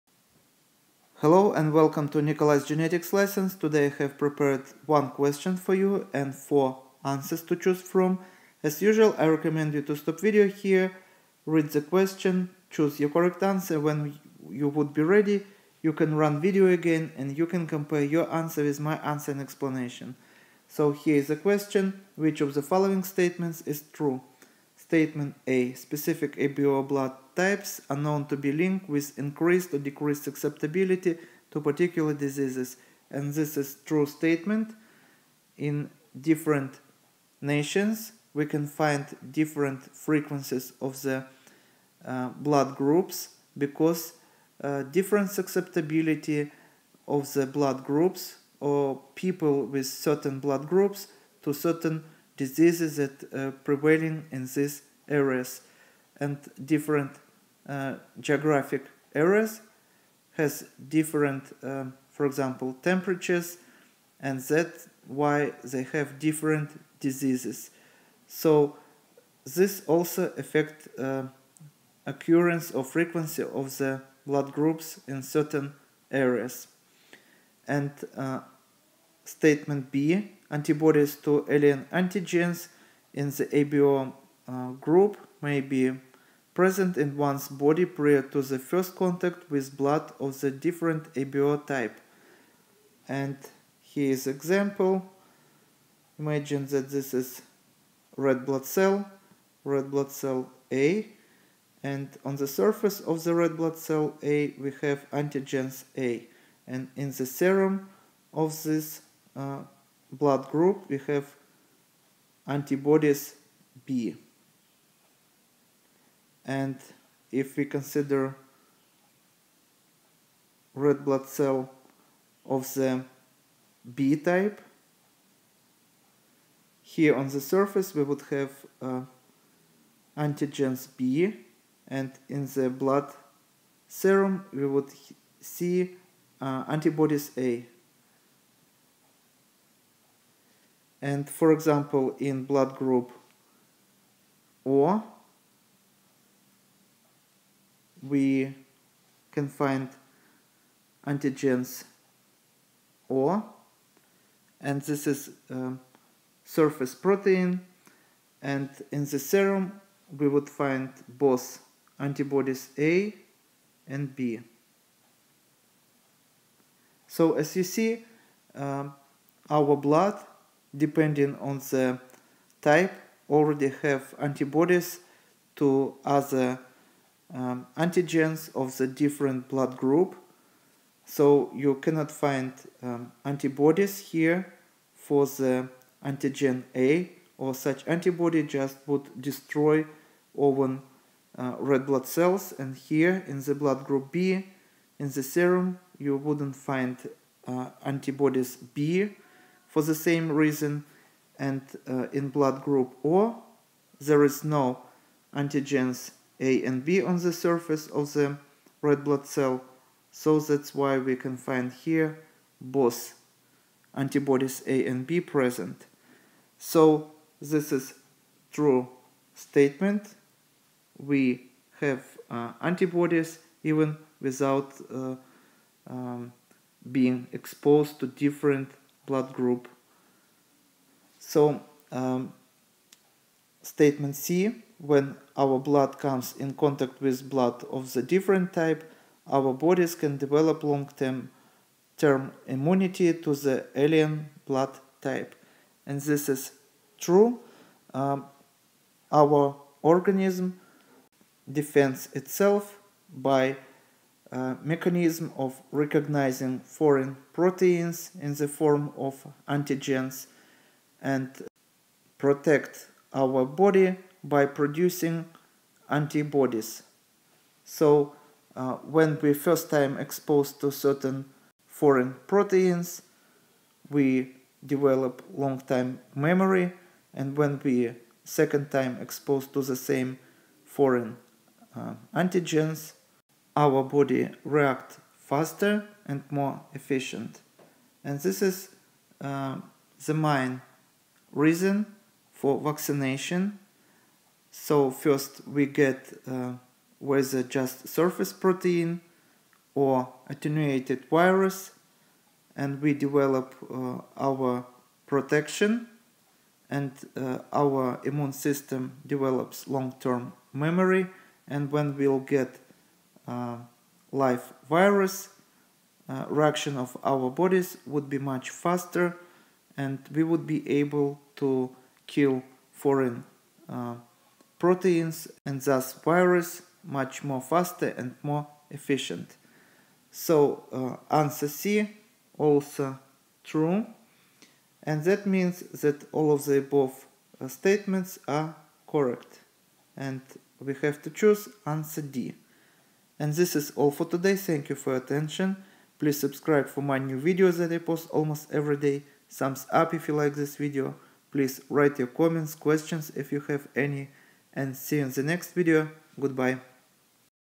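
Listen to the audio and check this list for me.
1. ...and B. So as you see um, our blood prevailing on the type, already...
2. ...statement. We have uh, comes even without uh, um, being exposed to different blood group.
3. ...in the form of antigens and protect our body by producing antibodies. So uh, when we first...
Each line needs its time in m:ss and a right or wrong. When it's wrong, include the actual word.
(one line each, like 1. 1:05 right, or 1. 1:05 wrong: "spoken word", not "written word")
1. 2:43 wrong: "depending", not "prevailing"
2. 3:39 wrong: "antibodies", not "comes"
3. 4:18 right.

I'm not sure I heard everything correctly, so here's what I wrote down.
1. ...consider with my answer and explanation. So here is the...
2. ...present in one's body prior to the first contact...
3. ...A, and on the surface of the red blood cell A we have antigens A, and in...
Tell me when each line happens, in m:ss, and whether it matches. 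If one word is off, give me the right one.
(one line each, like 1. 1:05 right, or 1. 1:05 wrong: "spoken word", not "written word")
1. 0:18 wrong: "answer", not "consider"
2. 1:26 right
3. 1:40 right.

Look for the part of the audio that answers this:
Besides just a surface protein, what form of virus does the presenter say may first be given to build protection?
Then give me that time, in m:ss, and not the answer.
5:00.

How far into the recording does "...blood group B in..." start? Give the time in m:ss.
3:13.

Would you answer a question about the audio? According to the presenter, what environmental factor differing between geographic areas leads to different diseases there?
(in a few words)
temperatures.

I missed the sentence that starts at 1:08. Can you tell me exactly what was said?
So this also affect uh, occurrence or frequency of the blood groups in certain areas.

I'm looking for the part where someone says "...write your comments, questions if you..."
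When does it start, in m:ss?
5:51.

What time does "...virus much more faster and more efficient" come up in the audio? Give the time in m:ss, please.
5:25.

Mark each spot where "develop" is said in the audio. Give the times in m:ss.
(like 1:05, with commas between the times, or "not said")
4:00, 4:34, 5:02, 5:09.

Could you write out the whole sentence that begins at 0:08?
As usual, I recommend you to stop video here, read the question, choose your correct answer.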